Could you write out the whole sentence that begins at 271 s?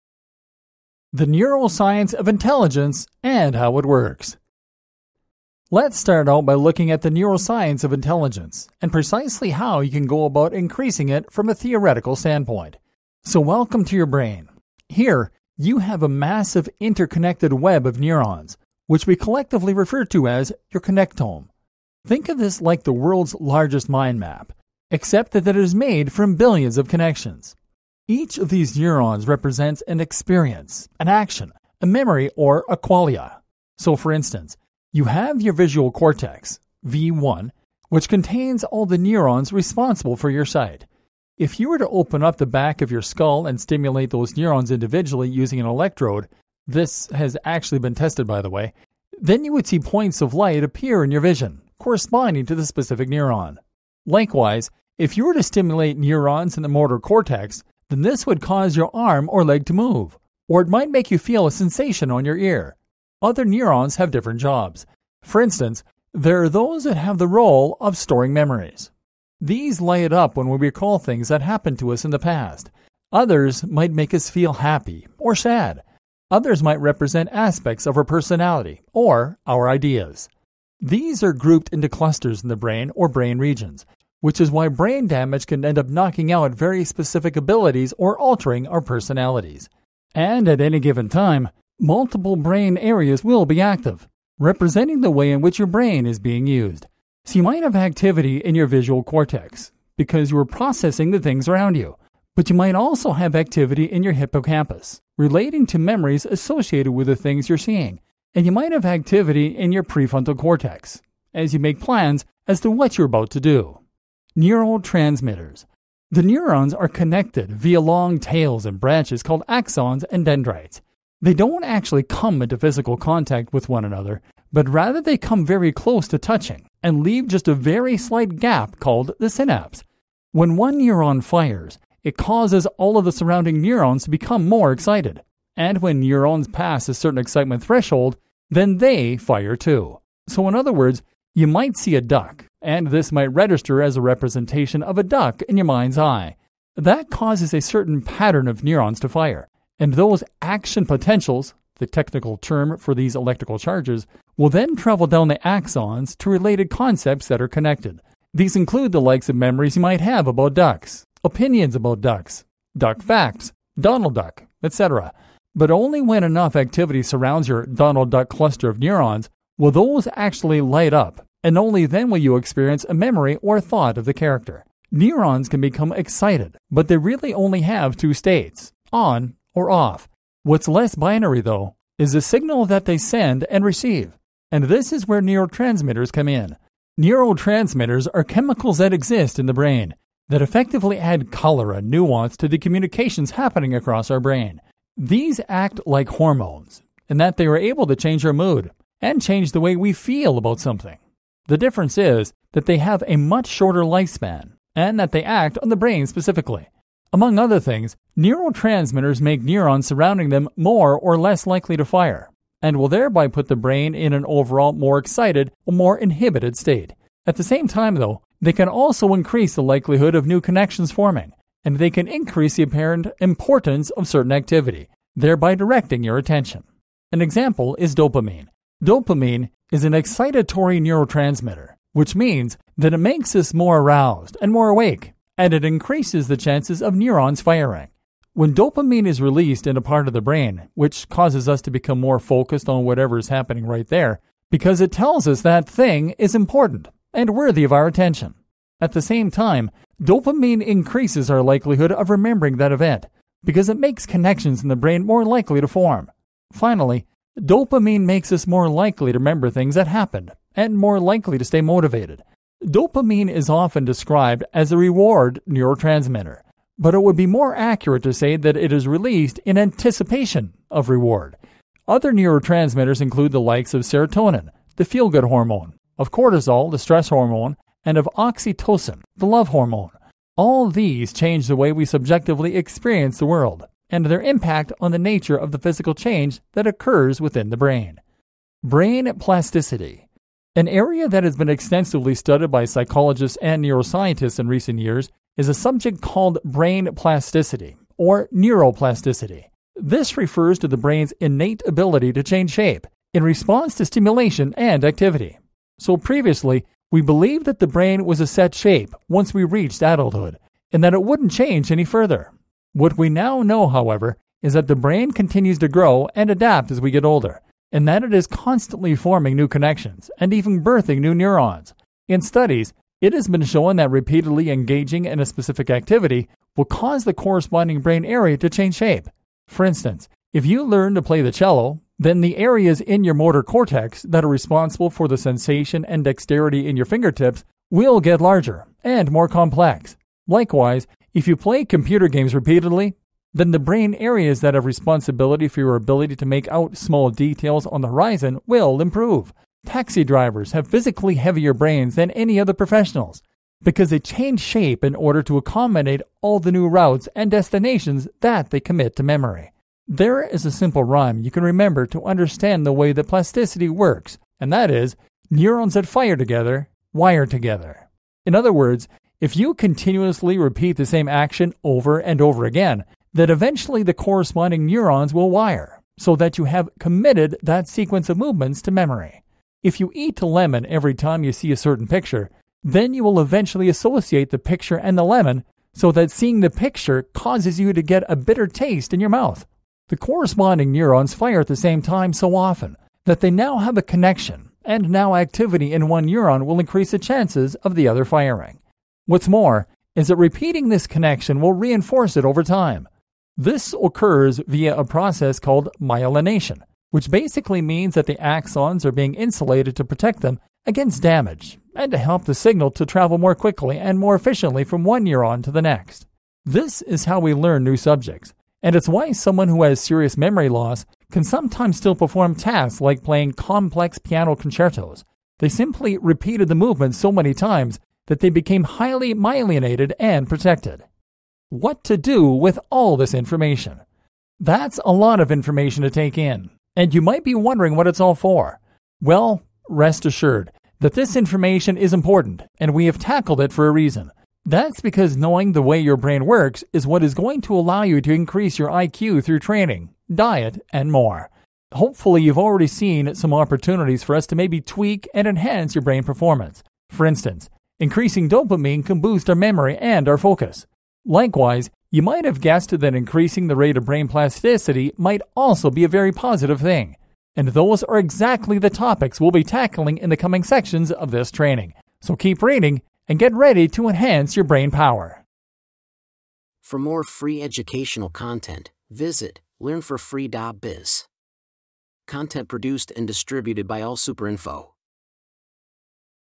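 Other neurotransmitters include the likes of serotonin, the feel good hormone, of cortisol, the stress hormone, and of oxytocin, the love hormone.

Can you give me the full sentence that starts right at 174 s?
Neurons can become excited, but they really only have two states on or off.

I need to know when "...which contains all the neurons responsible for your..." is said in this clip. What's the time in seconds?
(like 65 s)
37 s.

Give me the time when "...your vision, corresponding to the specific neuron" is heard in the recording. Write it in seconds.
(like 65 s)
51 s.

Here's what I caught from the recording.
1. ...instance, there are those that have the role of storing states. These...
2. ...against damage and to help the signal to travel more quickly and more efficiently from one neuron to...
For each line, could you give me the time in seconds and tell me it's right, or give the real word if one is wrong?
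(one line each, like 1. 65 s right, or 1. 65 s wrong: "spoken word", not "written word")
1. 65 s wrong: "memories", not "states"
2. 410 s right.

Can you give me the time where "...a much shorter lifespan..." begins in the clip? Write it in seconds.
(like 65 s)
203 s.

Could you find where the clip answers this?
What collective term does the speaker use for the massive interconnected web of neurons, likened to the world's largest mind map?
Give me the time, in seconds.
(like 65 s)
20 s.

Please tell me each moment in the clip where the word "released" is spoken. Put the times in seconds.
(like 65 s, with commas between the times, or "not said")
239 s, 268 s.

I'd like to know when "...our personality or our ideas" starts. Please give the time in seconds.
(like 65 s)
77 s.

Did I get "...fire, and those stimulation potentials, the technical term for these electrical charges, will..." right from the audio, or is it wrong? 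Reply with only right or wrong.
wrong.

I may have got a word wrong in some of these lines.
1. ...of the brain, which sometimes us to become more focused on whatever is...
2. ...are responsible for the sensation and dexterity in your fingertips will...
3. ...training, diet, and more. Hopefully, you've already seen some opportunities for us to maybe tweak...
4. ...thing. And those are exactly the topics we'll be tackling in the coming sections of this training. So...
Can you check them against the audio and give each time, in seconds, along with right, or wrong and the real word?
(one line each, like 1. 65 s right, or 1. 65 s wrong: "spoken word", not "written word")
1. 240 s wrong: "causes", not "sometimes"
2. 334 s right
3. 449 s right
4. 466 s right.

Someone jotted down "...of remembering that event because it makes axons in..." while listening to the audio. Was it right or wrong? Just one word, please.
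wrong.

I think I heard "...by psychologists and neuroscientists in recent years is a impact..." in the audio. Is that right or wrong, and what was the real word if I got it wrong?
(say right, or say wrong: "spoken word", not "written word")
wrong: "subject", not "impact".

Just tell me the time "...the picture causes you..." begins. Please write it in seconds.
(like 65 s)
386 s.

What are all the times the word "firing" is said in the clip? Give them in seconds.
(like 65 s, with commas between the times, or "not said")
237 s, 398 s.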